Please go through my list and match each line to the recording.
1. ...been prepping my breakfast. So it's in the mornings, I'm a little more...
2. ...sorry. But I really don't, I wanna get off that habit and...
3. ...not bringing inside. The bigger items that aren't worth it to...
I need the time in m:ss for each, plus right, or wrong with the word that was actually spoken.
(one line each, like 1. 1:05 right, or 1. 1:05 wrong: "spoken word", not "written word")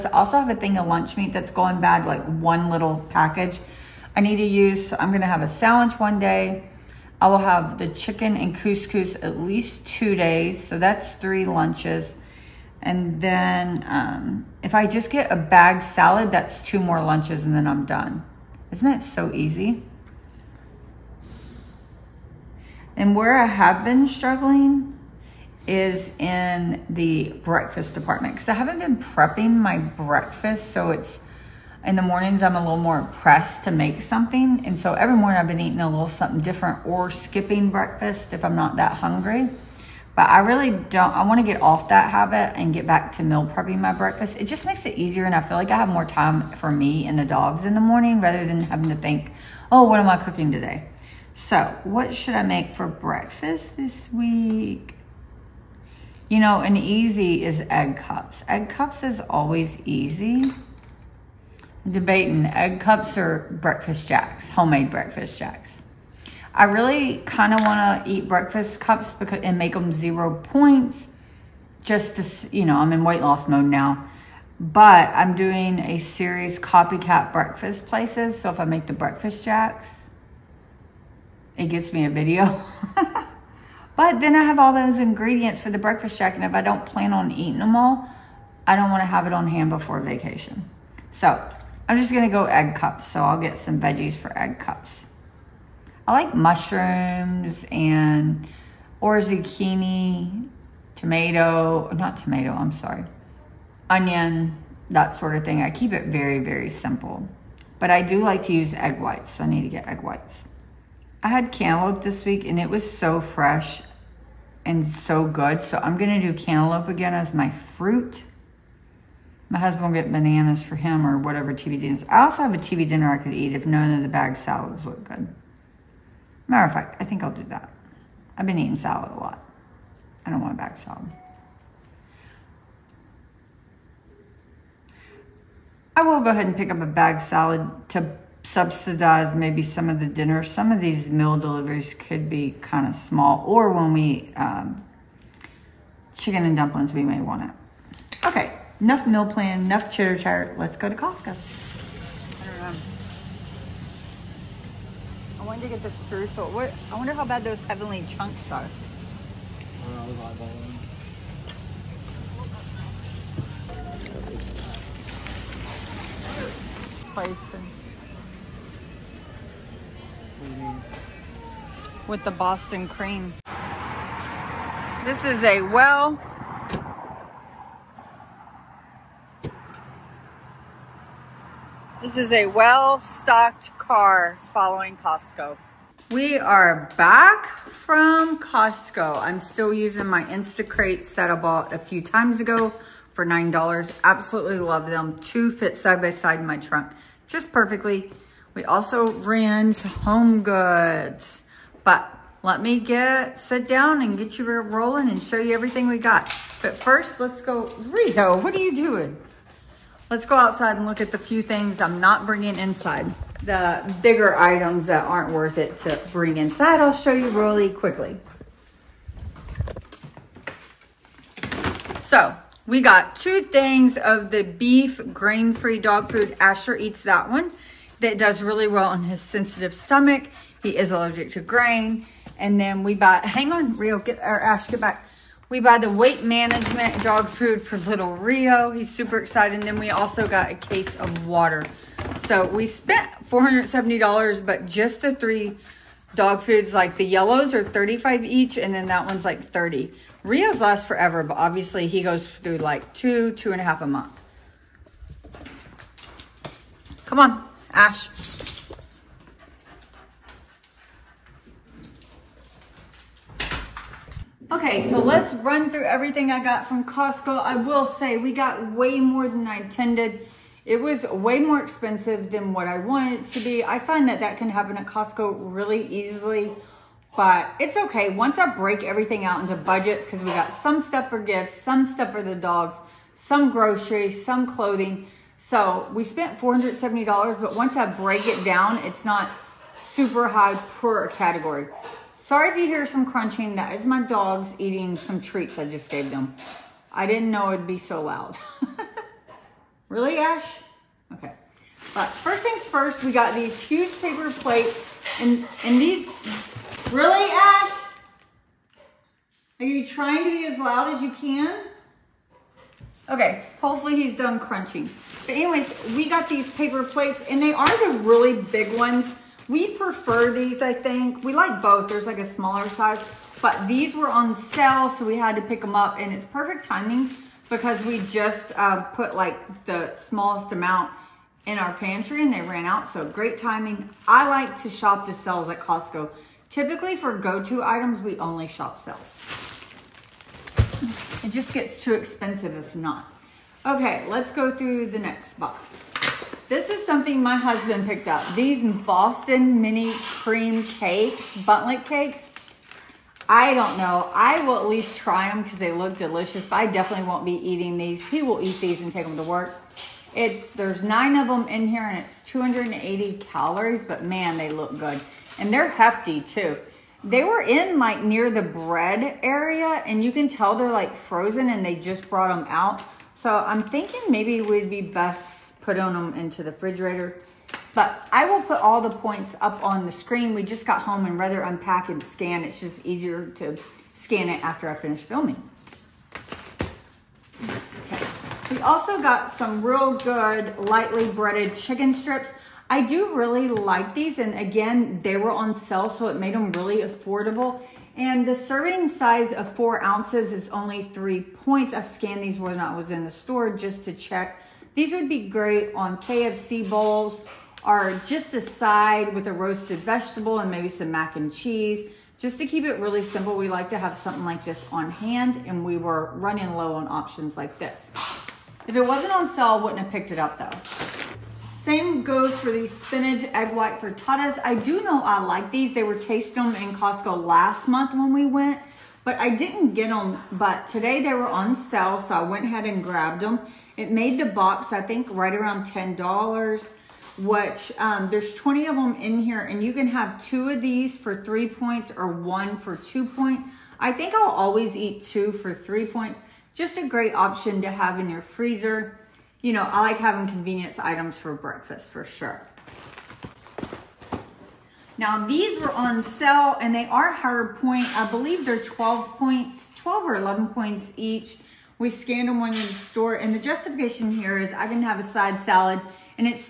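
1. 0:28 right
2. 0:38 wrong: "hungry", not "sorry"
3. 3:32 right.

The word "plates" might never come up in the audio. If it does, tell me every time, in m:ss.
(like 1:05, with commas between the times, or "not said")
5:04, 5:16.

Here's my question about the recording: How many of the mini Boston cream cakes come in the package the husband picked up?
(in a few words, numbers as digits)
9.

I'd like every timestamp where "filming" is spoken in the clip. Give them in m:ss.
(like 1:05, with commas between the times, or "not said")
6:25.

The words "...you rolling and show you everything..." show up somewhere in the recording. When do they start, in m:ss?
3:24.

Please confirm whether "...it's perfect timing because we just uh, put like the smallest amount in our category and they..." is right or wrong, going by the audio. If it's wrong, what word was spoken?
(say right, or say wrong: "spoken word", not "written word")
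wrong: "pantry", not "category".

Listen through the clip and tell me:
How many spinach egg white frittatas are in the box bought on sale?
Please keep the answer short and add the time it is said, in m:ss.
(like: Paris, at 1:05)
20, at 7:18.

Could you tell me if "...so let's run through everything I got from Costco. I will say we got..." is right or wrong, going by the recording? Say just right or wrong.
right.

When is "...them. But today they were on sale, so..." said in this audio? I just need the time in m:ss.
7:09.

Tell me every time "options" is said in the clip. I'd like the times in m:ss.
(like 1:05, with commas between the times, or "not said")
6:56, 7:27.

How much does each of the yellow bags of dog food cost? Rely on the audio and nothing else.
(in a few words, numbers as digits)
35.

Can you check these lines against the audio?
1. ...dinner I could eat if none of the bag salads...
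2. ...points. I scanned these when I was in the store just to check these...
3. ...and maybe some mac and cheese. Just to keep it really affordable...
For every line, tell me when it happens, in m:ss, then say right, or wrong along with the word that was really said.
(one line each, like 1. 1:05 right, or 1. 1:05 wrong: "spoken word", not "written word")
1. 2:02 right
2. 6:41 right
3. 6:50 wrong: "simple", not "affordable".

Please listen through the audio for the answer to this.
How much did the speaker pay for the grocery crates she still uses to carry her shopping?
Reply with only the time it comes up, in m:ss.
3:13.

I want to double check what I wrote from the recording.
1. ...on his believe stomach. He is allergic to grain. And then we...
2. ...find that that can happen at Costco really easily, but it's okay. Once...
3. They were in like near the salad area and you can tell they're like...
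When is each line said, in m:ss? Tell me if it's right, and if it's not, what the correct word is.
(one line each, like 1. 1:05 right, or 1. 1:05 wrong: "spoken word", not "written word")
1. 3:48 wrong: "sensitive", not "believe"
2. 4:33 right
3. 6:07 wrong: "bread", not "salad".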